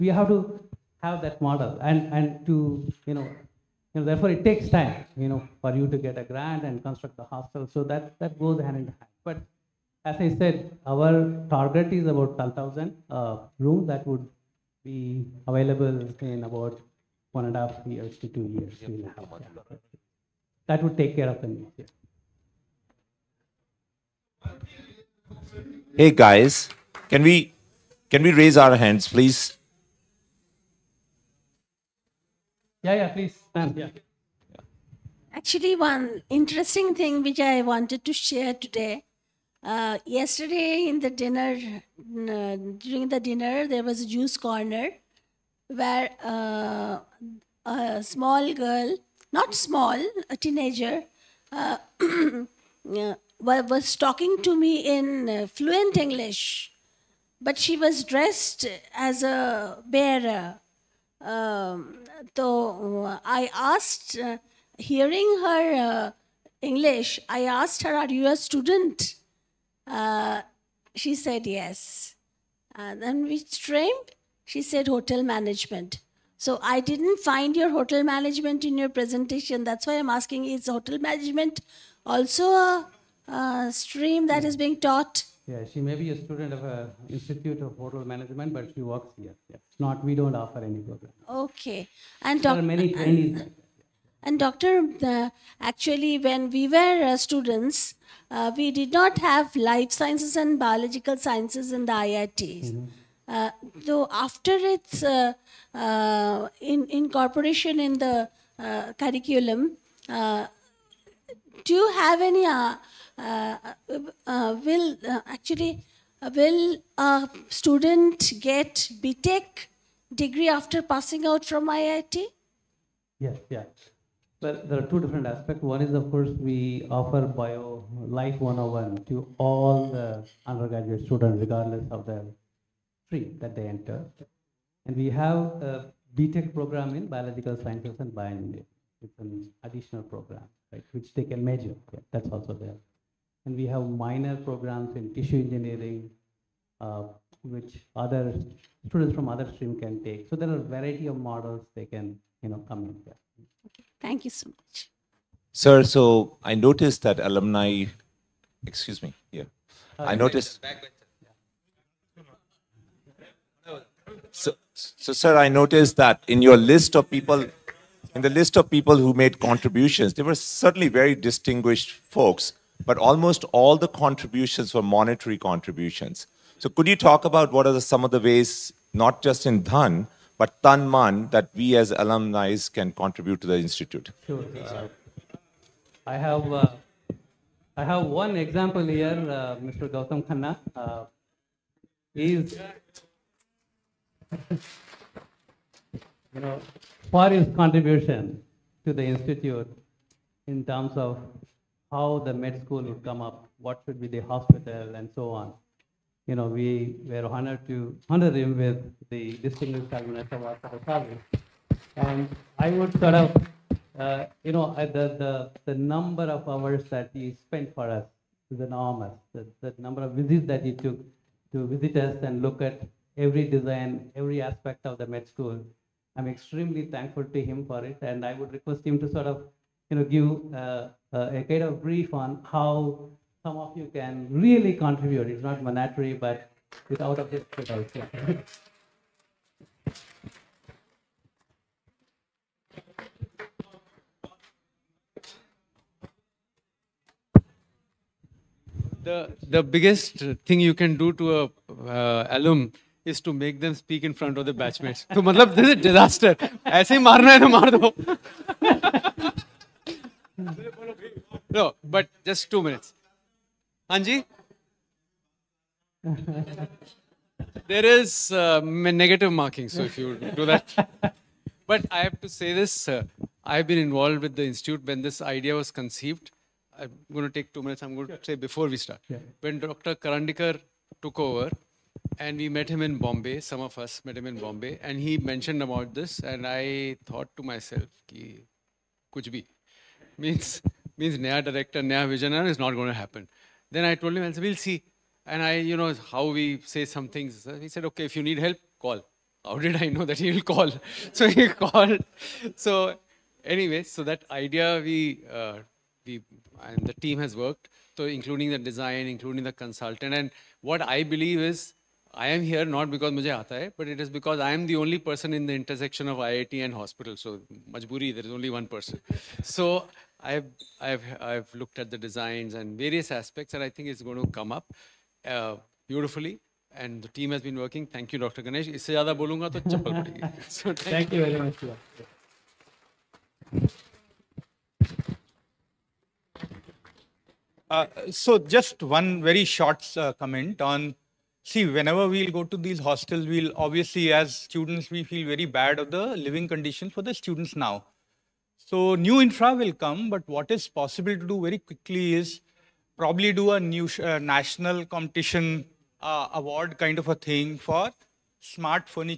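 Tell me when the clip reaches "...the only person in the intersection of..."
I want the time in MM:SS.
05:14.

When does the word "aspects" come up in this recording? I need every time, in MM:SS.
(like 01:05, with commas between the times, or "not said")
02:05, 03:44, 05:23.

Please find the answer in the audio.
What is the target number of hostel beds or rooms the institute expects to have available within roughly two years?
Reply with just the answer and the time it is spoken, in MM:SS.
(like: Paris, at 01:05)
12,000, at 00:12.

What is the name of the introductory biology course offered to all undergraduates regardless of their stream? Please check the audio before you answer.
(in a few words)
Bio Life 101.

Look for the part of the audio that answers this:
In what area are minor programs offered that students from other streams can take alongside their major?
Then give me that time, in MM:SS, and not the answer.
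02:25.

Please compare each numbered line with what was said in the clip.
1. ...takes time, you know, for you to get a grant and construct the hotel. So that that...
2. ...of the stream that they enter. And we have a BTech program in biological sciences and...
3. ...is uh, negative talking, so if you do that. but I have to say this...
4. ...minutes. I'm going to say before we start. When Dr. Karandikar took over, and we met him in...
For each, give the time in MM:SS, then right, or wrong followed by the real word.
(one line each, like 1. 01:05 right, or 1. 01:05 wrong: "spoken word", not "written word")
1. 00:04 wrong: "hostel", not "hotel"
2. 02:11 right
3. 04:27 wrong: "marking", not "talking"
4. 04:37 right.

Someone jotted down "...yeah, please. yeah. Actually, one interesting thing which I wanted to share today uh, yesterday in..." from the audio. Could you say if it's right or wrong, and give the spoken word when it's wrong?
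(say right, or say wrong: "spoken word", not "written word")
right.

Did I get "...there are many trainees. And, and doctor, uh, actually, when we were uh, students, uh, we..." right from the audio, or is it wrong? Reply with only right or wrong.
right.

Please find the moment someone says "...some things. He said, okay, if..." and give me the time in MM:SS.
04:56.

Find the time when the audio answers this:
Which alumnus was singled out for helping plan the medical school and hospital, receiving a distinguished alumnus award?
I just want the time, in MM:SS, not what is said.
03:09.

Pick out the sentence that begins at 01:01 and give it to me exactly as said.
Um, so uh, I asked, hearing her English, I asked her, Are you a student?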